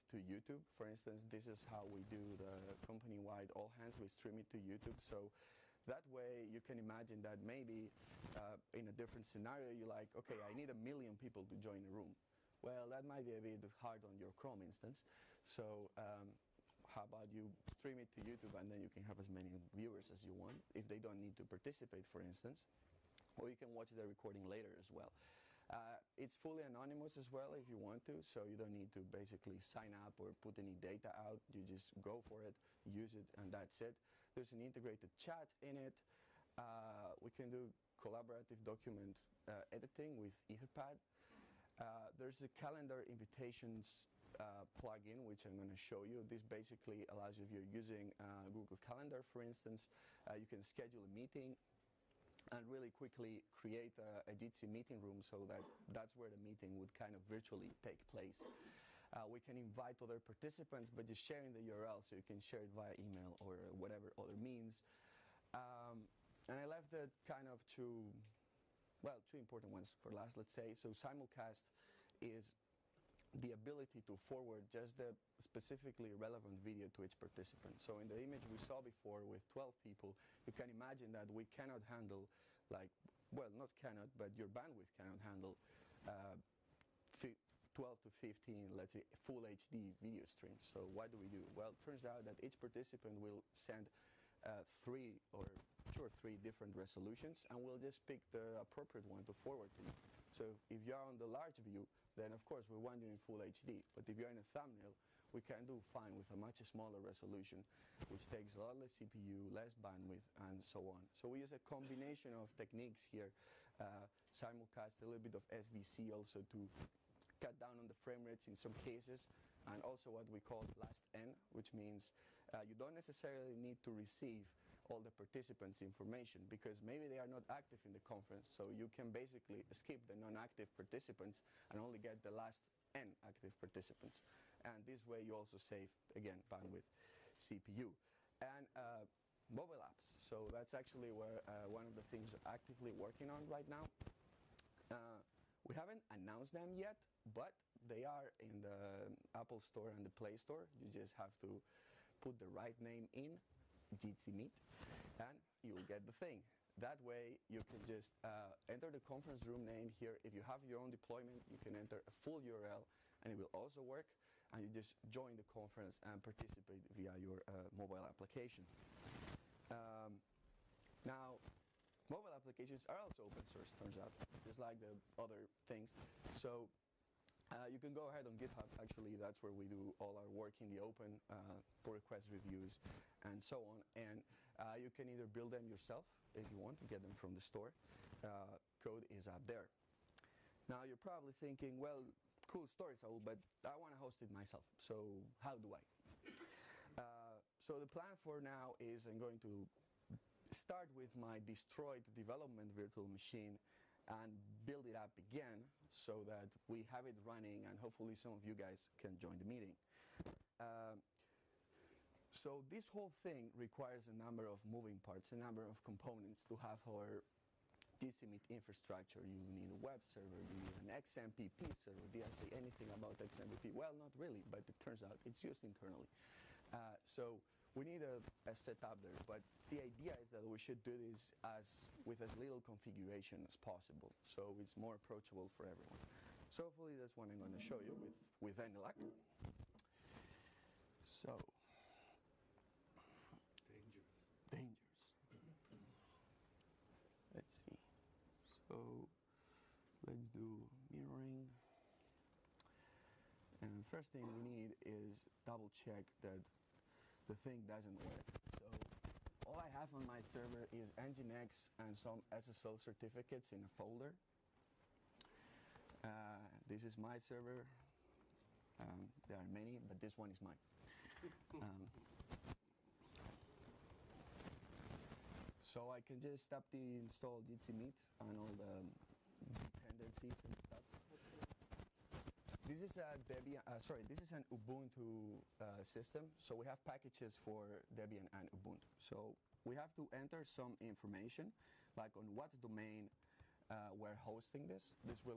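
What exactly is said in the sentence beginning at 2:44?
And you just join the conference and participate via your uh, mobile application.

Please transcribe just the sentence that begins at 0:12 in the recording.
Well, that might be a bit hard on your Chrome instance.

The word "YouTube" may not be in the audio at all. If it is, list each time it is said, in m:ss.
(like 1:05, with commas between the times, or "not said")
0:00, 0:04, 0:18.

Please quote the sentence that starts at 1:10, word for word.
So simulcast is the ability to forward just the specifically relevant video to each participant.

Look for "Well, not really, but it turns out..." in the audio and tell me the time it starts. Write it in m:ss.
3:43.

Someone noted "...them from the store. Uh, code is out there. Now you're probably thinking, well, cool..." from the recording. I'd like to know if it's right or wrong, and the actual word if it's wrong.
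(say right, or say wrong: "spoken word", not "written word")
right.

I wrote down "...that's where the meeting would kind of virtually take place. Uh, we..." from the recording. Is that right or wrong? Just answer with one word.
right.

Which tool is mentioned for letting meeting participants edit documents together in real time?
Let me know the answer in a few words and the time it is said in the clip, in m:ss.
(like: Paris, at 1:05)
Etherpad, at 0:40.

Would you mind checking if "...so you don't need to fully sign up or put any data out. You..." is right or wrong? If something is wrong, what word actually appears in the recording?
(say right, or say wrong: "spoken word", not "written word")
wrong: "basically", not "fully".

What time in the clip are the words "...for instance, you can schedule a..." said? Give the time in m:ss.
0:49.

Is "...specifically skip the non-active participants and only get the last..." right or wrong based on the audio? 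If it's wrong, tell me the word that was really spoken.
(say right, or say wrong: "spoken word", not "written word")
wrong: "basically", not "specifically".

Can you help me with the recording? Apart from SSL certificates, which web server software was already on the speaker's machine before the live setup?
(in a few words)
Nginx.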